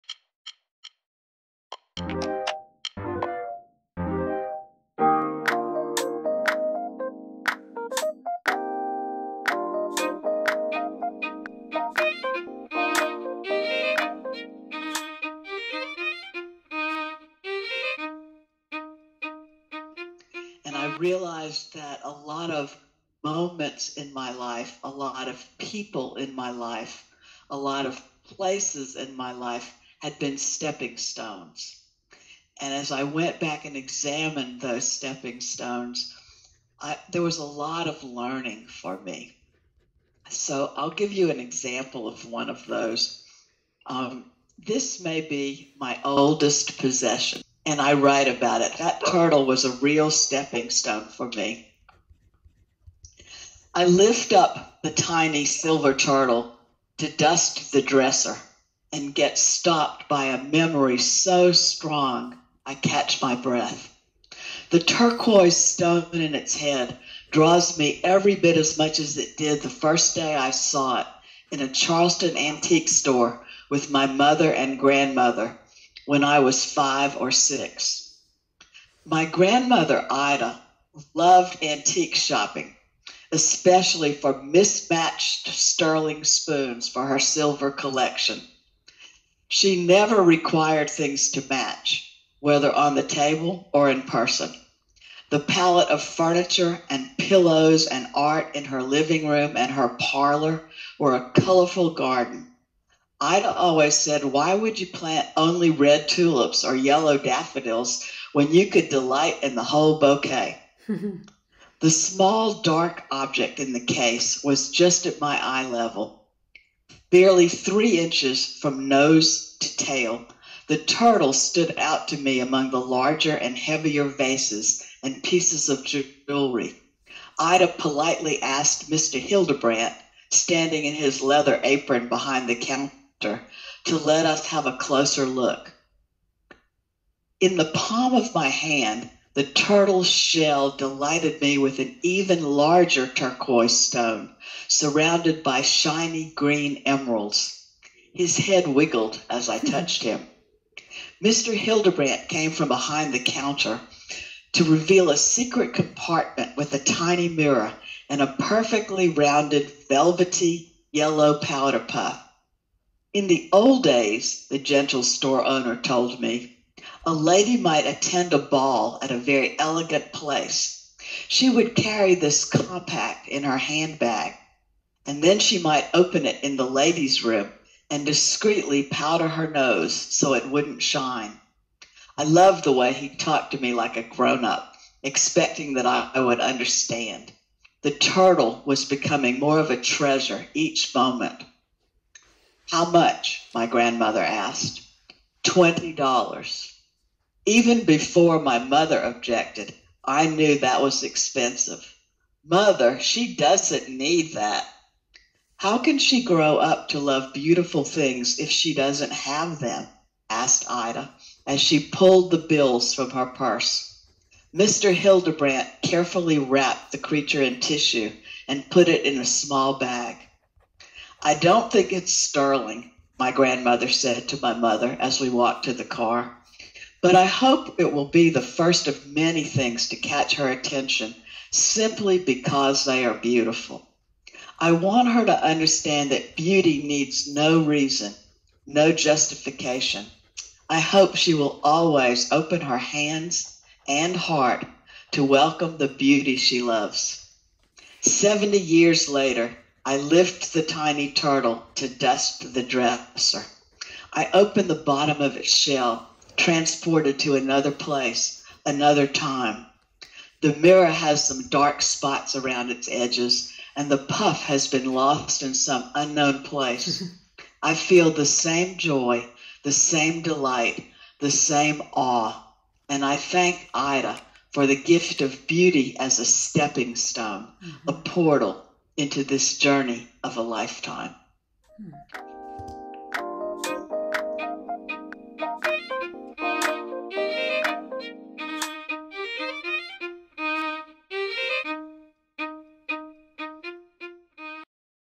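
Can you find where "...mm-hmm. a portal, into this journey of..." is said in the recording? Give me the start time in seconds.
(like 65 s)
277 s.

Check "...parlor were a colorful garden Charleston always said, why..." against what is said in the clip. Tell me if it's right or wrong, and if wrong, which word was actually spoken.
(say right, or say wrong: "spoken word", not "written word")
wrong: "Ida", not "Charleston".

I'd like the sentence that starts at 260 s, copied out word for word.
The mirror has some dark spots around its edges, and the puff has been lost in some unknown place.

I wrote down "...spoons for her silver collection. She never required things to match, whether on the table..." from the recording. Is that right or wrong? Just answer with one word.
right.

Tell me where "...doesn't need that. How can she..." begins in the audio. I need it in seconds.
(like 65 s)
203 s.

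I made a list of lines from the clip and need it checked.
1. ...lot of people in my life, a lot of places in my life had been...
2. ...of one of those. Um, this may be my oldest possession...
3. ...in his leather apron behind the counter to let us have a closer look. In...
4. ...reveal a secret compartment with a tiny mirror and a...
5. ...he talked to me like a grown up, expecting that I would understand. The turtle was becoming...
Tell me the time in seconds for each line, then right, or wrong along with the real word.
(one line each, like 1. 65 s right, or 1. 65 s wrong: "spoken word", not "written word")
1. 24 s right
2. 42 s right
3. 130 s right
4. 154 s right
5. 182 s right.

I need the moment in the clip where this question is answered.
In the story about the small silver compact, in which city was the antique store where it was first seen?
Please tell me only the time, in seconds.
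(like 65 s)
71 s.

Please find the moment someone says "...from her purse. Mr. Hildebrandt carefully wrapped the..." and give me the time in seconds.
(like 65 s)
212 s.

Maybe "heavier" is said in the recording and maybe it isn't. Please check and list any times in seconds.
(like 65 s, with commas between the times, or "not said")
123 s.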